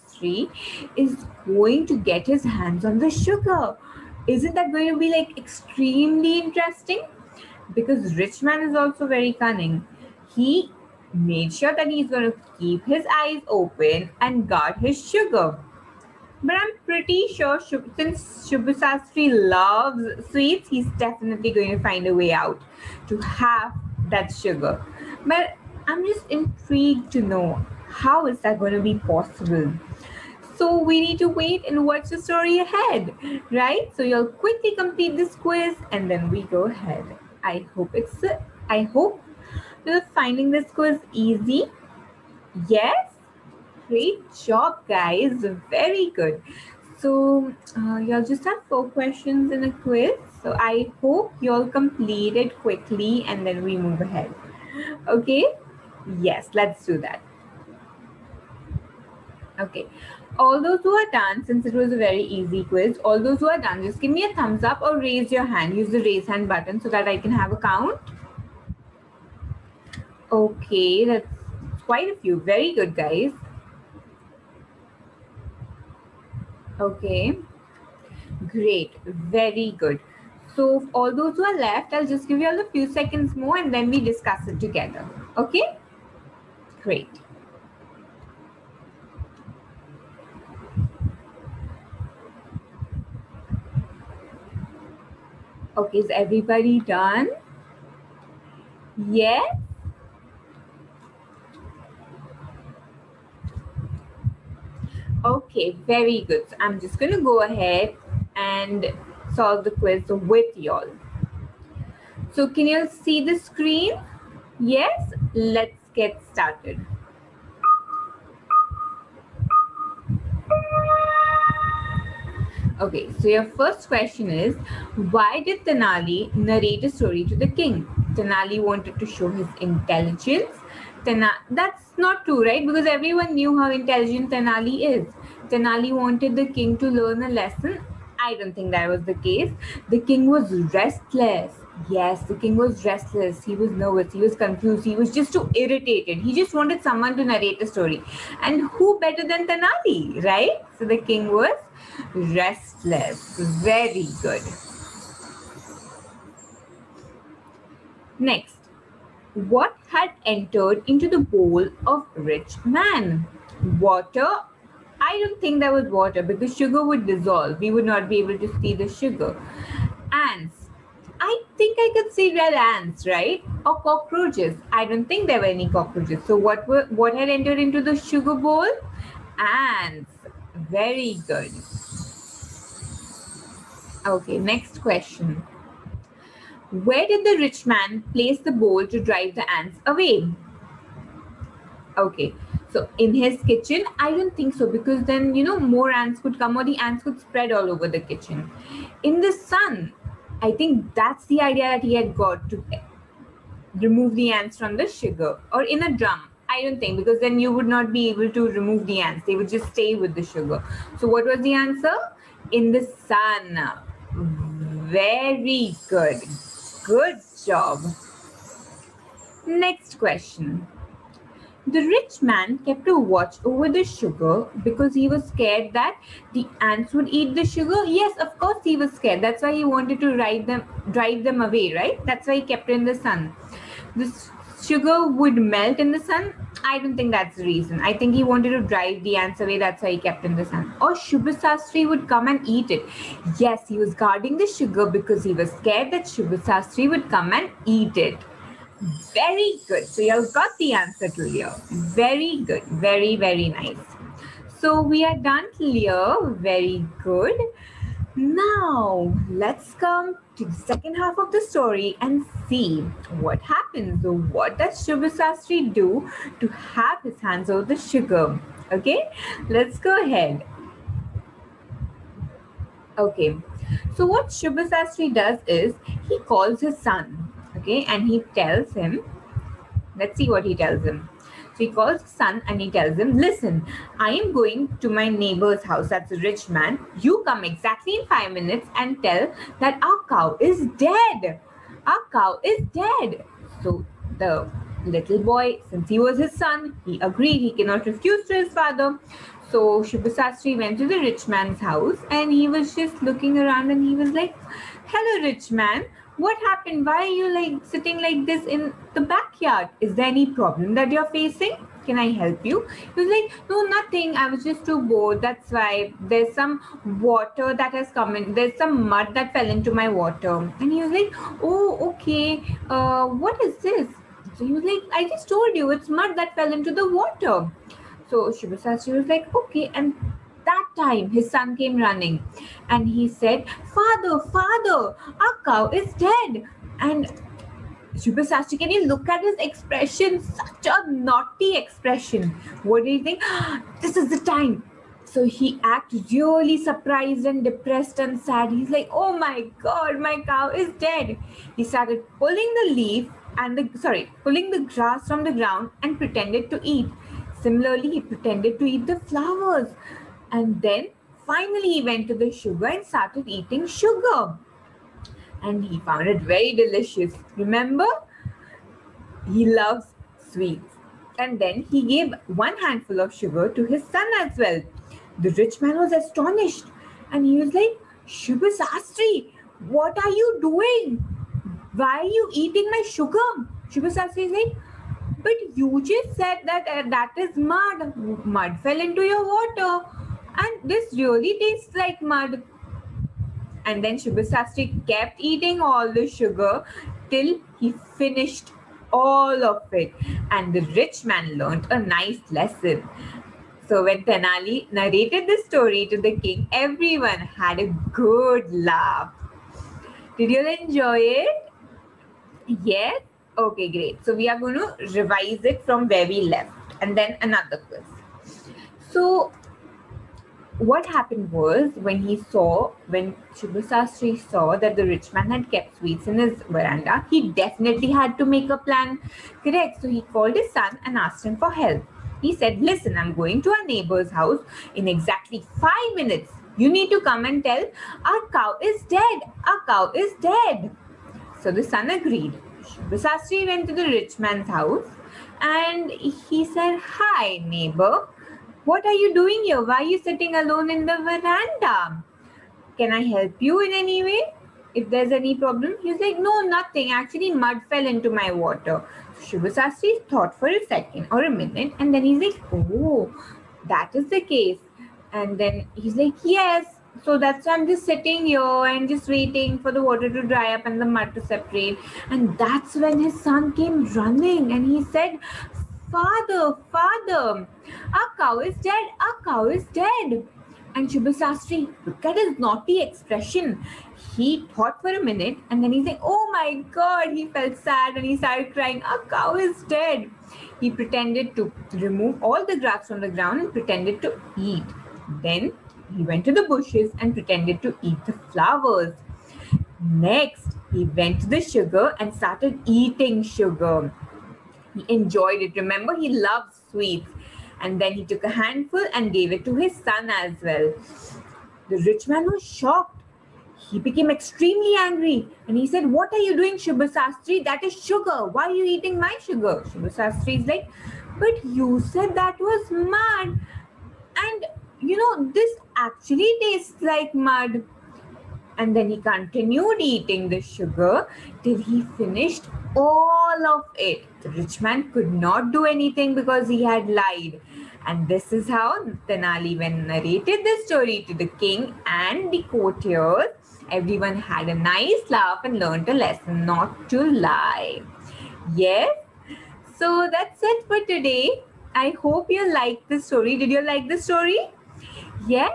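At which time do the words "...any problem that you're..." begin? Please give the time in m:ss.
5:10.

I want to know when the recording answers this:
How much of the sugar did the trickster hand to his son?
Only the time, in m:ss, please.
6:12.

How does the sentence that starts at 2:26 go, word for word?
He just wanted someone to narrate the story.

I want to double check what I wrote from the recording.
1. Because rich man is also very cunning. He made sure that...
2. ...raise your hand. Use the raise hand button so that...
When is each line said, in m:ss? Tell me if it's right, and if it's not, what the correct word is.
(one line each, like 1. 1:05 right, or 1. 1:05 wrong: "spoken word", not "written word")
1. 0:07 right
2. 1:04 right.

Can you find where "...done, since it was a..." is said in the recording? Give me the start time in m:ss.
1:01.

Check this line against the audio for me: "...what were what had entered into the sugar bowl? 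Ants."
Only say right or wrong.
right.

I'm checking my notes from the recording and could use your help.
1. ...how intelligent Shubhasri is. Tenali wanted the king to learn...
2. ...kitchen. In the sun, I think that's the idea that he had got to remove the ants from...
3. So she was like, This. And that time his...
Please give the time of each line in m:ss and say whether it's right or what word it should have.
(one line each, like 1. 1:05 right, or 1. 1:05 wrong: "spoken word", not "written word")
1. 2:13 wrong: "Tenali", not "Shubhasri"
2. 3:18 right
3. 5:28 wrong: "Okay", not "This".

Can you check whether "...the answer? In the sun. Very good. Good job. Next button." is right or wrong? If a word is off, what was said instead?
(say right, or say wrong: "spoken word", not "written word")
wrong: "question", not "button".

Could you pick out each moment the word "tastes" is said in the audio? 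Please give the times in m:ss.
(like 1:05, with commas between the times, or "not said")
6:31, 8:46.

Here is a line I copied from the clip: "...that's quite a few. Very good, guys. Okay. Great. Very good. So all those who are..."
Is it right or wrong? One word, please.
right.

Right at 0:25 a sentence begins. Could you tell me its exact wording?
But I'm just intrigued to know how is that going to be possible?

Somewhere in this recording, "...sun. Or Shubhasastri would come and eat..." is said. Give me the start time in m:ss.
4:00.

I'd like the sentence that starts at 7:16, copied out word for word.
You need to come and tell, Our cow is dead.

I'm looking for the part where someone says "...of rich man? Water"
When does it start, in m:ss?
2:41.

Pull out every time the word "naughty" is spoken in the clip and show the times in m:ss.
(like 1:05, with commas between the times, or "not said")
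5:40, 8:02.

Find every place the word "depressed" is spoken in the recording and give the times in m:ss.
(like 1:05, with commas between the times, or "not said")
5:47.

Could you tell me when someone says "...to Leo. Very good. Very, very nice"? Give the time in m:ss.
4:11.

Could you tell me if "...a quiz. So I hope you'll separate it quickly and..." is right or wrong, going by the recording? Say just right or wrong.
wrong.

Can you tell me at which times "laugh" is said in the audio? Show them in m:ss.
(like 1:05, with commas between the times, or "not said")
6:48, 9:05.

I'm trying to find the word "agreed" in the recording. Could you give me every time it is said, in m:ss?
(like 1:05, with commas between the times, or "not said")
4:57, 7:21.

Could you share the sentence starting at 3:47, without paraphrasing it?
Yes, of course he was scared.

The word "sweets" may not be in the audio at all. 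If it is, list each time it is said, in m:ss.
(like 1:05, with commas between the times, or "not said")
0:20, 6:10, 7:05, 8:26.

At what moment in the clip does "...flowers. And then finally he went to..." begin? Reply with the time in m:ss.
5:59.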